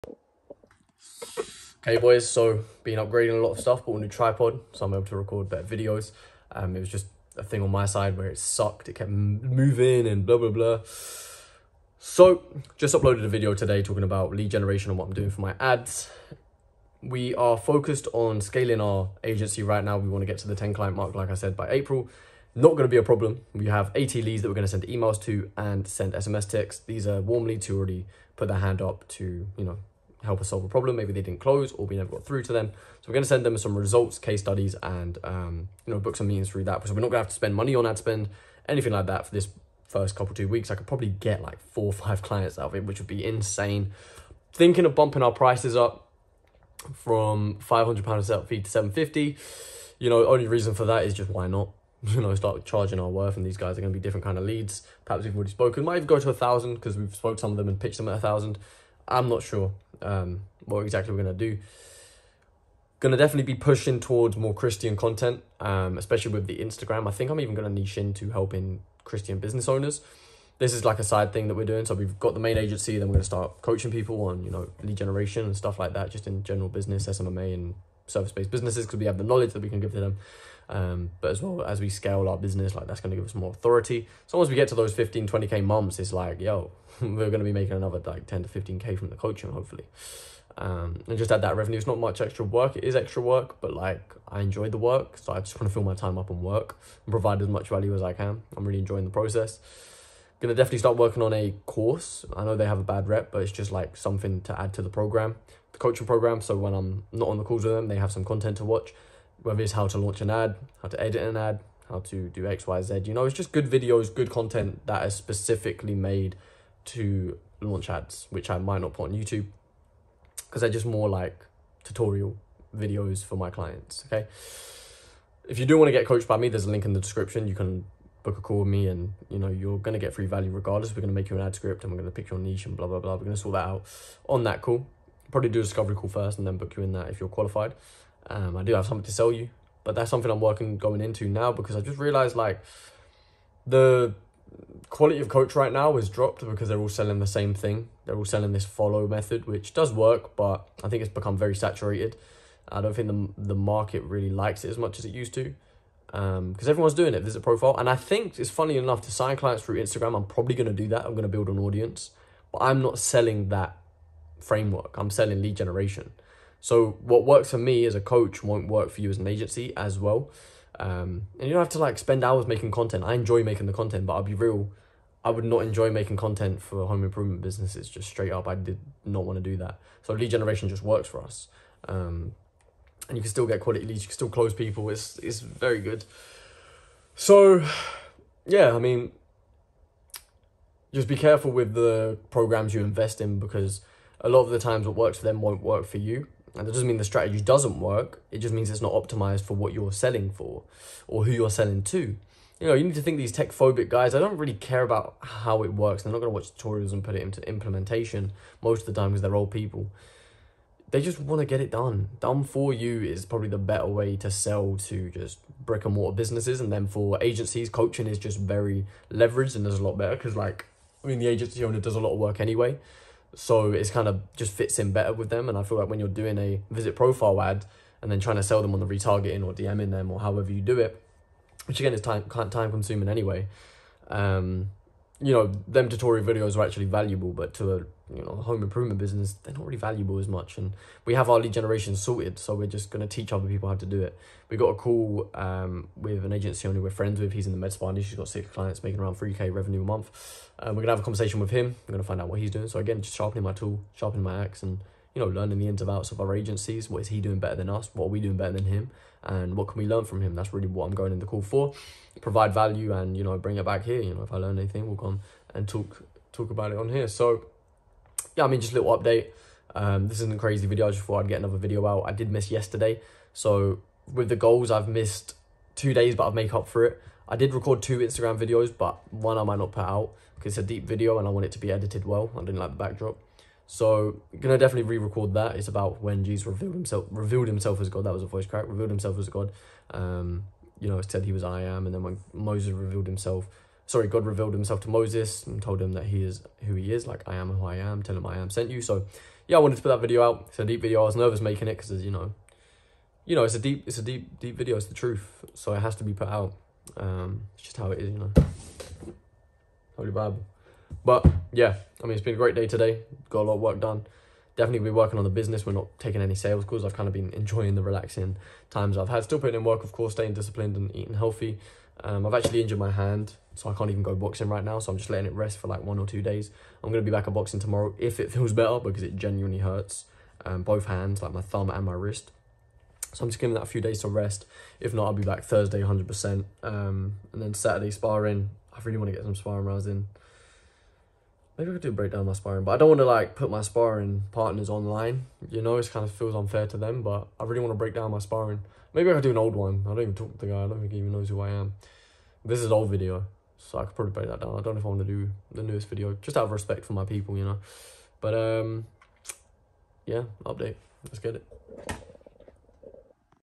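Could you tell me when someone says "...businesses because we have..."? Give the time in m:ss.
1:18.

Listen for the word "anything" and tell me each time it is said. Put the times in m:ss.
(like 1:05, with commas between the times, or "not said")
0:38, 4:24.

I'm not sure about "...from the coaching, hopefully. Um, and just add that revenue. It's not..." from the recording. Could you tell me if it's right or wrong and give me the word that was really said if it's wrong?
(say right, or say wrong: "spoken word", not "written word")
right.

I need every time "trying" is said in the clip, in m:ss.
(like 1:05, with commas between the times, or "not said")
3:48.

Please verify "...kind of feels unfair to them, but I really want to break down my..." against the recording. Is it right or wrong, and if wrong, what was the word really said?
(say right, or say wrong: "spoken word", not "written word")
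right.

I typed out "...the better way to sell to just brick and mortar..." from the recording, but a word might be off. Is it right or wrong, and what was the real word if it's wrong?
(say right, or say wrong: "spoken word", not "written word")
right.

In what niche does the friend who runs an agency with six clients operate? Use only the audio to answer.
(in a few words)
Med spa.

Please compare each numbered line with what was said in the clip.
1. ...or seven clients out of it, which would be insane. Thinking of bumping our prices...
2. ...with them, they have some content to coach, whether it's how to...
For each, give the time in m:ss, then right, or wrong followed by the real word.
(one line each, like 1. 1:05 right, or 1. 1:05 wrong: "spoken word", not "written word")
1. 0:41 wrong: "five", not "seven"
2. 1:47 wrong: "watch", not "coach".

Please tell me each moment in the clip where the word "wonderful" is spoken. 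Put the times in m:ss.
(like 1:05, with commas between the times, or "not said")
not said.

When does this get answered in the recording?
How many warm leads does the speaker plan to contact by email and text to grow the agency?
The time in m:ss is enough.
0:23.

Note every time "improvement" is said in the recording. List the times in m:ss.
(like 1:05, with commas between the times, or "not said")
2:57, 3:58.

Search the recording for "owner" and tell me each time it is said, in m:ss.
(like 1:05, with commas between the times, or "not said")
1:09, 3:41, 4:06.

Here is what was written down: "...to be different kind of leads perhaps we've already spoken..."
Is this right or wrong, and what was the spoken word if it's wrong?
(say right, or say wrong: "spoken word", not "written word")
right.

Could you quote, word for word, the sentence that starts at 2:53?
I enjoy making the content, but I'll be real.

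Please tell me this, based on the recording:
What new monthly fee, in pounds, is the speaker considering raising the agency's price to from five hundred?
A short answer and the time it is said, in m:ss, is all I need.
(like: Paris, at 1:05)
750, at 0:48.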